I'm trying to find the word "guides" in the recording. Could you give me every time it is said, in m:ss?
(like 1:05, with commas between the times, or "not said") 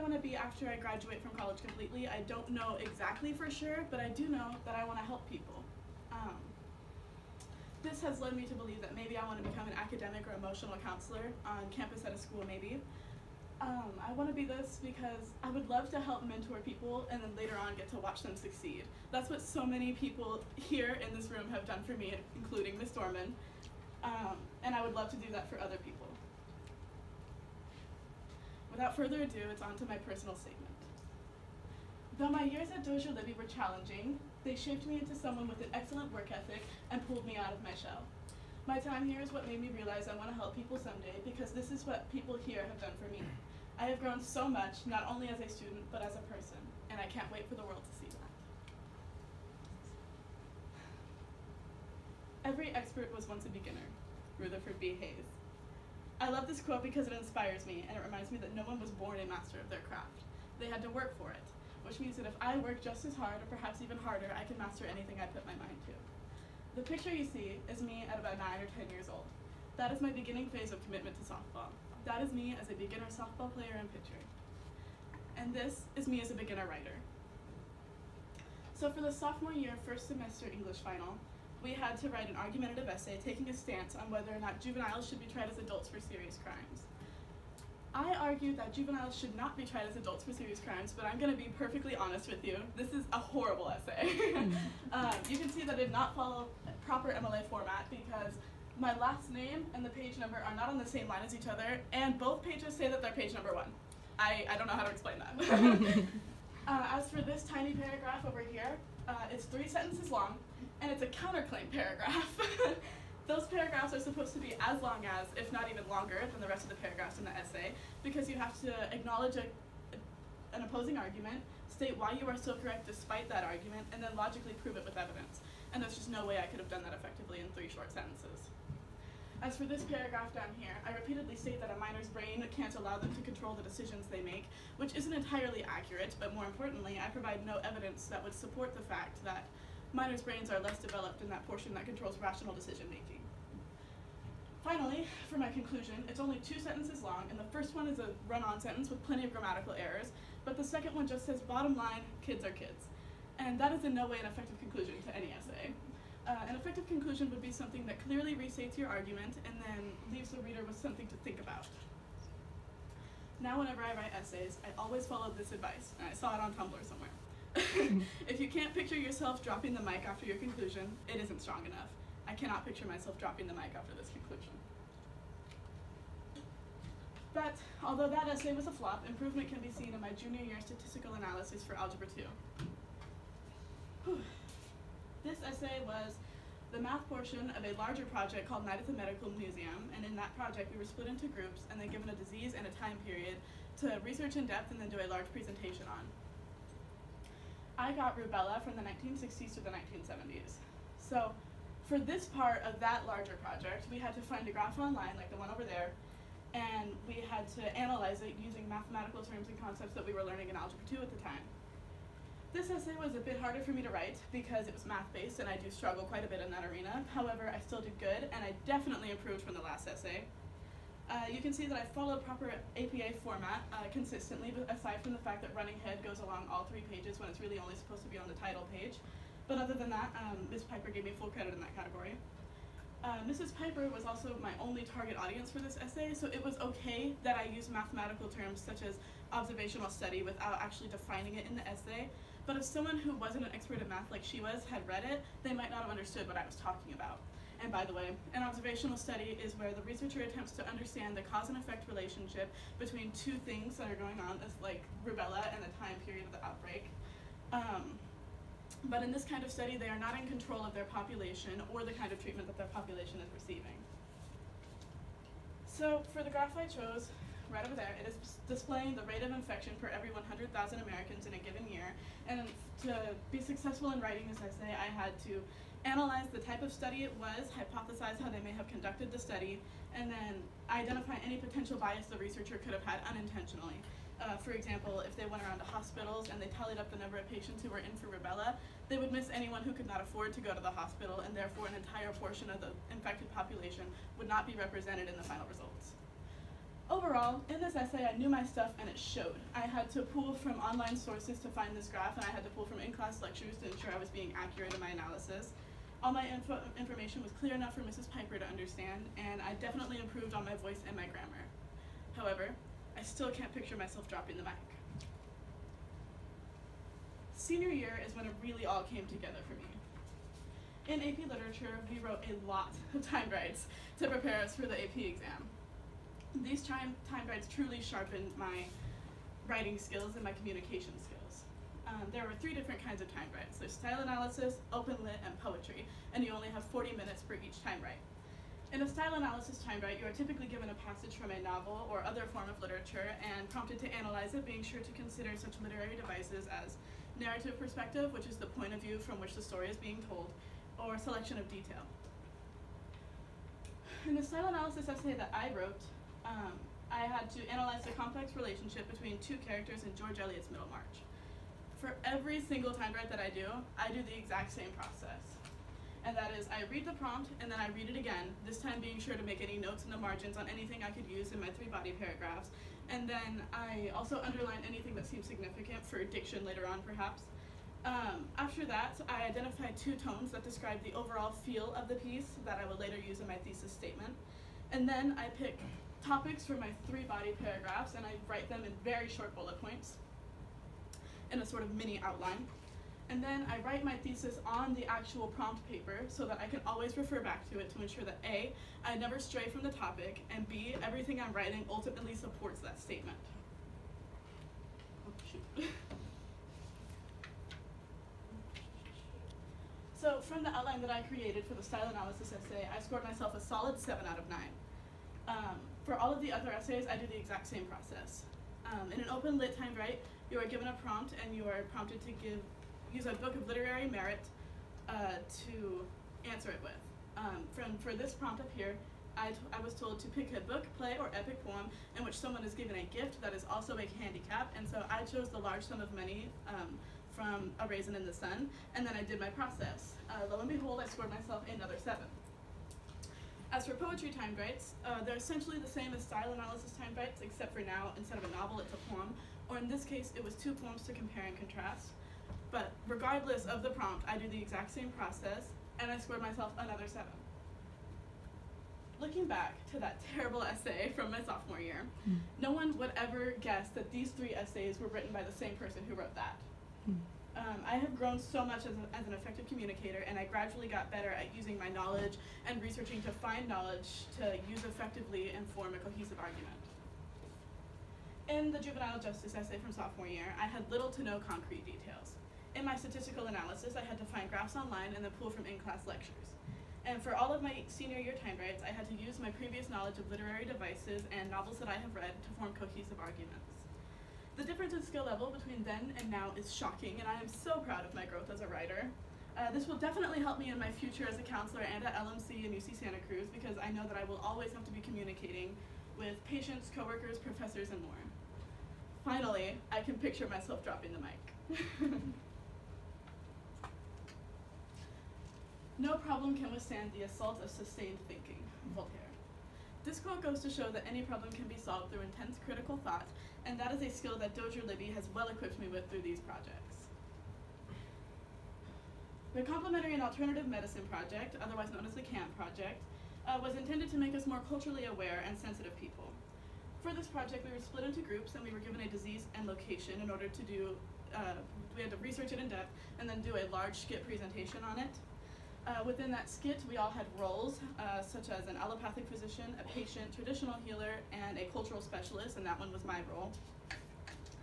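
5:27, 5:33.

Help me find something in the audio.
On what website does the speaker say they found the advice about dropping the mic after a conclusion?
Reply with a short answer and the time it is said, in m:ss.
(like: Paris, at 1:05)
Tumblr, at 2:46.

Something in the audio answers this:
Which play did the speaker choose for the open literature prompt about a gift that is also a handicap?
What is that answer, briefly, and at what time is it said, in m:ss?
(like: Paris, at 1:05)
A Raisin in the Sun, at 7:17.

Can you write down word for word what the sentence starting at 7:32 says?
But regardless of the prompt, I do the exact same process, and I scored myself another seven.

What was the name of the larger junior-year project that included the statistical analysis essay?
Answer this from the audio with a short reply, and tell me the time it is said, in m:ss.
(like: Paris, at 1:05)
Night at the Medical Museum, at 3:08.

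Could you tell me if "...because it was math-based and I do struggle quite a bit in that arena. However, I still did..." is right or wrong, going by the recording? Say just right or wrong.
right.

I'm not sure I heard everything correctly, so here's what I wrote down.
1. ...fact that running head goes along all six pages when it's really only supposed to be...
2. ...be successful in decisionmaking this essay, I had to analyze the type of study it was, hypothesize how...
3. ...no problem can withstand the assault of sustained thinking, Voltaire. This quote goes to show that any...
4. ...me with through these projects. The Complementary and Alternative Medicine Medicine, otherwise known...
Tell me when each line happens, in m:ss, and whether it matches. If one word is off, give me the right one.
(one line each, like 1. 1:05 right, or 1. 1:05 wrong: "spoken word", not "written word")
1. 3:45 wrong: "three", not "six"
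2. 4:33 wrong: "writing", not "decisionmaking"
3. 8:35 right
4. 8:45 wrong: "Project", not "Medicine".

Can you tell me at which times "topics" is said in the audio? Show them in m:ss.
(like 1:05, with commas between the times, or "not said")
6:26, 6:39.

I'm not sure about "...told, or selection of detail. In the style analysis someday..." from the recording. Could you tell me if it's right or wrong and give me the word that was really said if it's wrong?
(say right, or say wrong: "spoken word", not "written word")
wrong: "essay", not "someday".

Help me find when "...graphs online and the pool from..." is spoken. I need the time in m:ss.
8:04.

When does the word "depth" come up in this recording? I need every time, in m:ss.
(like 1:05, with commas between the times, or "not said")
3:14, 9:02.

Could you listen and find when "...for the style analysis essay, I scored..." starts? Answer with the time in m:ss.
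6:51.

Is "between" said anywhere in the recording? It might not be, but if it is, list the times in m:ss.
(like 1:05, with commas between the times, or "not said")
4:12, 5:58, 8:15.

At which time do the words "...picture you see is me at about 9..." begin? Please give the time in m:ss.
1:06.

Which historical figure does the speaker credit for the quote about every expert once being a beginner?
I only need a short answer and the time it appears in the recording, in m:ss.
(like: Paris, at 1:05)
Rutherford B. Hayes, at 0:54.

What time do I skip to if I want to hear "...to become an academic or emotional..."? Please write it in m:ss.
0:09.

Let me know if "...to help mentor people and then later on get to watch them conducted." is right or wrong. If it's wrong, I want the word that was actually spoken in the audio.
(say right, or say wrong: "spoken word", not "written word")
wrong: "succeed", not "conducted".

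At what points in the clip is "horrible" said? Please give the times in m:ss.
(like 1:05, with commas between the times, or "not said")
1:33.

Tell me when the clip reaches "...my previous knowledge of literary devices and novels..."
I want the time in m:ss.
8:09.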